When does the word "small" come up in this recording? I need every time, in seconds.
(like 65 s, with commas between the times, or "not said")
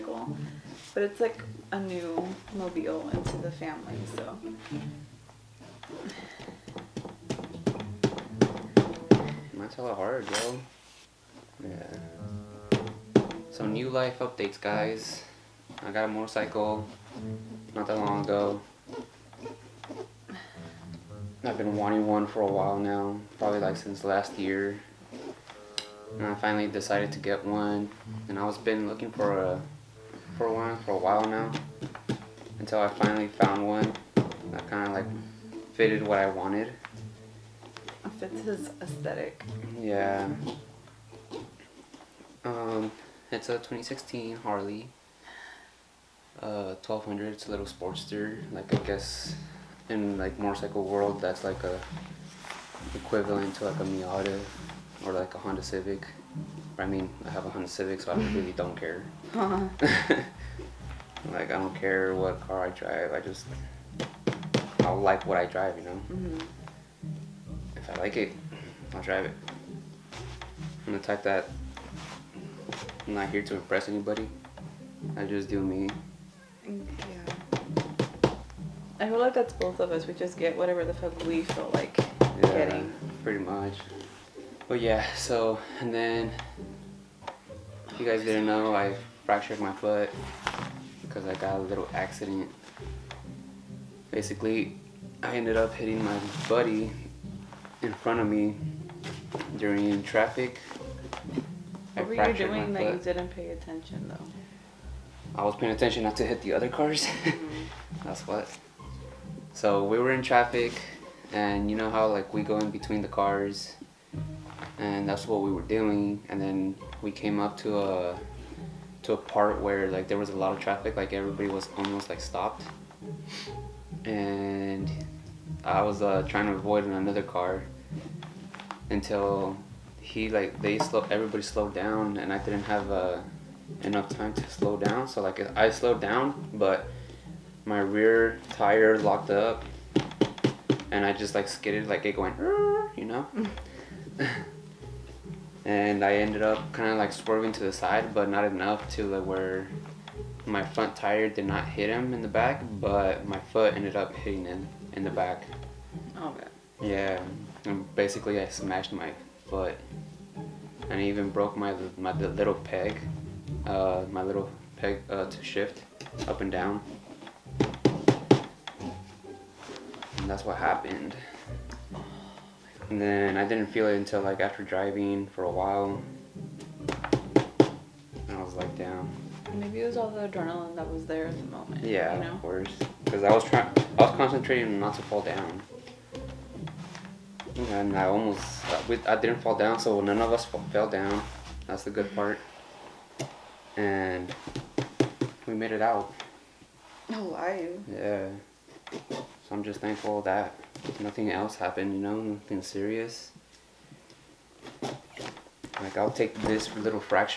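not said.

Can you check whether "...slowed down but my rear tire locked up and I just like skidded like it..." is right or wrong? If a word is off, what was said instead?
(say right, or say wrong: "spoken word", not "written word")
right.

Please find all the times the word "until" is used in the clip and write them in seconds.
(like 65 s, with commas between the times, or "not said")
32 s, 128 s, 173 s.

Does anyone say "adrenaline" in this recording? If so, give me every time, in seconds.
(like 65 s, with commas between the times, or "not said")
180 s.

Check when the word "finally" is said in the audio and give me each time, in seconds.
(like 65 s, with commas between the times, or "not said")
26 s, 32 s.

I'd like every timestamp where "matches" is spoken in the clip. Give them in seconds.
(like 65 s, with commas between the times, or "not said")
not said.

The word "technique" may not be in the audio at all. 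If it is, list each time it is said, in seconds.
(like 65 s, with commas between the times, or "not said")
not said.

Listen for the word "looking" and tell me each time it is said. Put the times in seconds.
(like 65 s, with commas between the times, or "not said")
28 s.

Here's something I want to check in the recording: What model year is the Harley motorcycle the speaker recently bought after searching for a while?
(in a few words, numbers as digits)
2016.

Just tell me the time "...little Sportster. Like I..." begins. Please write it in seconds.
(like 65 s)
47 s.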